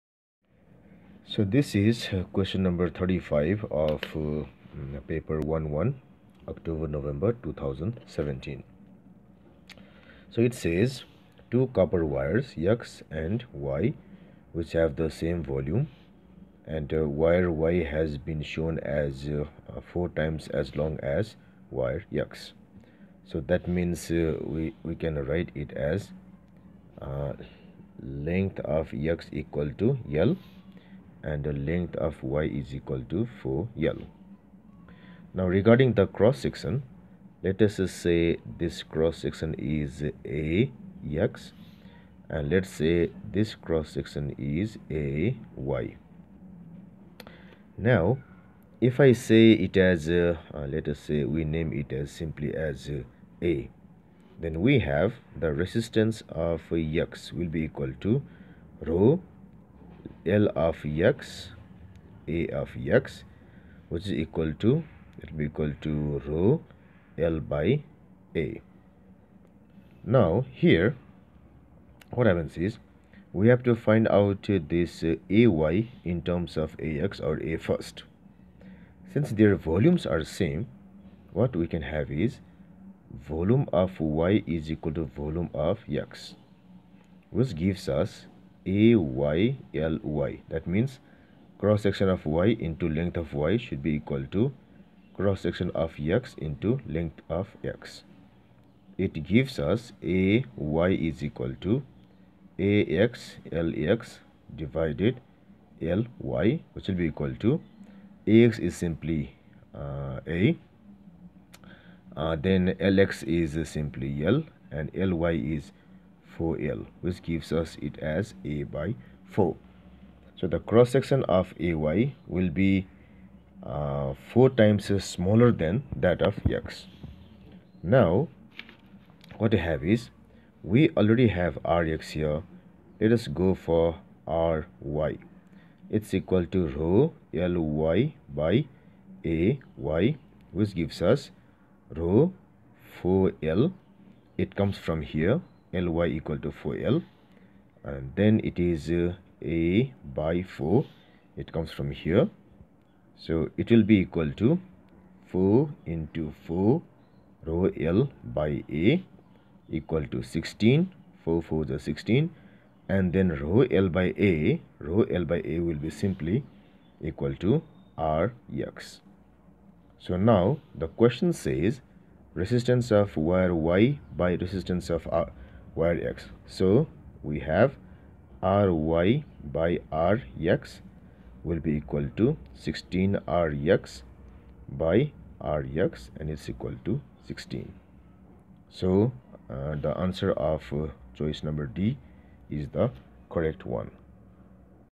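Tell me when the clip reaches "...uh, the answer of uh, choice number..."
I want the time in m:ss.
3:09.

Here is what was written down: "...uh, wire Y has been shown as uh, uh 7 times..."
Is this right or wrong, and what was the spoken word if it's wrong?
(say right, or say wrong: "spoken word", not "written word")
wrong: "4", not "7".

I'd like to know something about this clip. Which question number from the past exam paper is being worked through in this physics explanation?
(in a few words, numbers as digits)
35.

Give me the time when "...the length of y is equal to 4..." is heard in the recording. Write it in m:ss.
0:31.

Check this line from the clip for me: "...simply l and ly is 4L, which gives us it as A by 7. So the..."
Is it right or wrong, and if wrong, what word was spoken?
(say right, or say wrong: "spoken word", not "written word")
wrong: "4", not "7".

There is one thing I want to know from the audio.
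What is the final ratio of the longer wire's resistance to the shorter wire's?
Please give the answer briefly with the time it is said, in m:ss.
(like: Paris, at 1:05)
16, at 3:06.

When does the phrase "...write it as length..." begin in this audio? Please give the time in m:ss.
0:25.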